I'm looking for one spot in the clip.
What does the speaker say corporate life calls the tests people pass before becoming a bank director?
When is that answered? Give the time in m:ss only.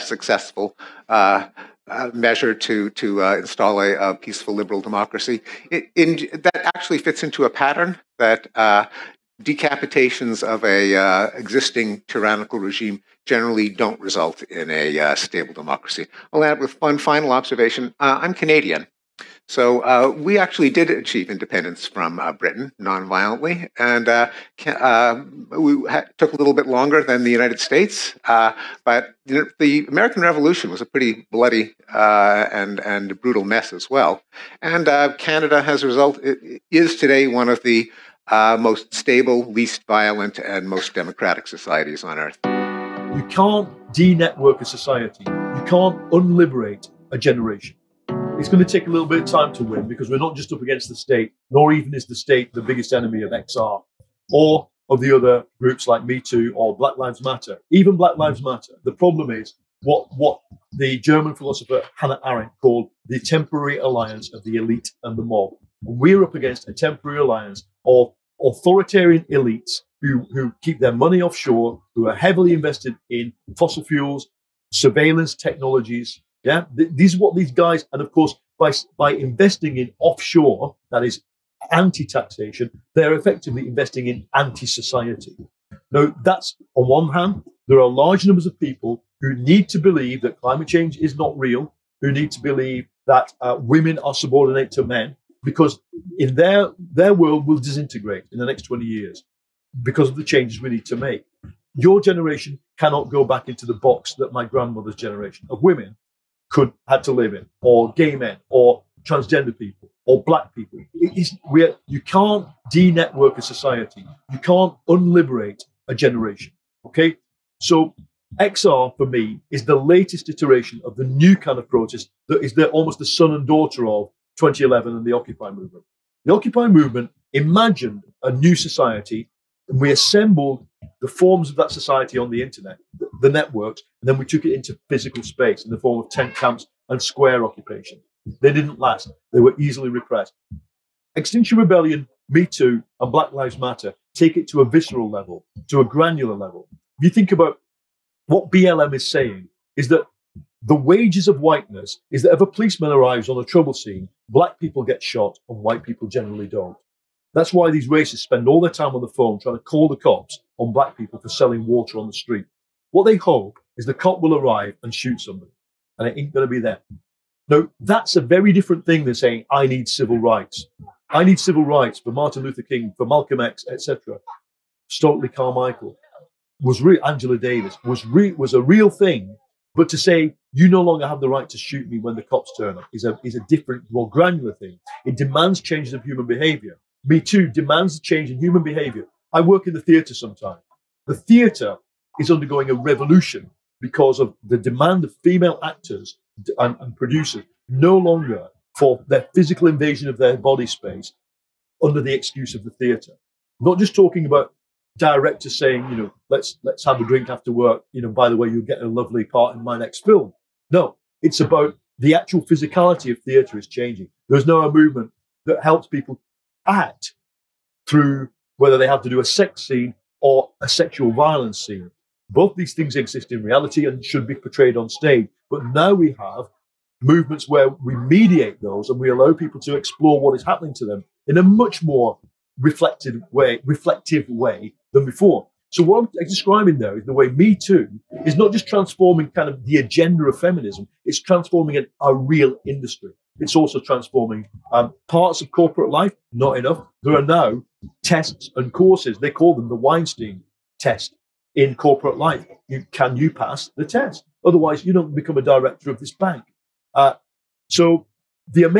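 4:09.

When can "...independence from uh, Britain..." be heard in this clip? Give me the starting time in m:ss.
0:21.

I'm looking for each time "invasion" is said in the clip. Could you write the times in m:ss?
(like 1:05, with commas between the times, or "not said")
3:19.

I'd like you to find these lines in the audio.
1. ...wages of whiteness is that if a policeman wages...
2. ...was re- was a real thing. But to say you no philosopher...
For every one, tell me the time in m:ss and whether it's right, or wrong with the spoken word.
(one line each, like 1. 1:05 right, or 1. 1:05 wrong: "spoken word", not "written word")
1. 2:30 wrong: "arrives", not "wages"
2. 2:57 wrong: "longer", not "philosopher".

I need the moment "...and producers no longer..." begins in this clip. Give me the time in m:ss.
3:16.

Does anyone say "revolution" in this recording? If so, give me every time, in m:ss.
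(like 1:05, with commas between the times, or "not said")
0:30, 3:12.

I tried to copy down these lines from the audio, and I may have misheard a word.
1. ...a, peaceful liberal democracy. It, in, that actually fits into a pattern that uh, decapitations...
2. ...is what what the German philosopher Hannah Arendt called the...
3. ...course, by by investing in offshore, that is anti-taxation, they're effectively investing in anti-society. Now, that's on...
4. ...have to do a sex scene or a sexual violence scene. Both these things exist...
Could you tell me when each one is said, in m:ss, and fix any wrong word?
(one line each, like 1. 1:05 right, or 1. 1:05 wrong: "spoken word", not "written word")
1. 0:03 right
2. 0:59 right
3. 1:18 right
4. 3:38 right.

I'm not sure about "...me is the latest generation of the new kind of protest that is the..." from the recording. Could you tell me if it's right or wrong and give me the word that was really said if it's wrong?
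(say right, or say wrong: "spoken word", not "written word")
wrong: "iteration", not "generation".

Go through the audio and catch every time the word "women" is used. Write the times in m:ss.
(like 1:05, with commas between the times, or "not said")
1:33, 1:45.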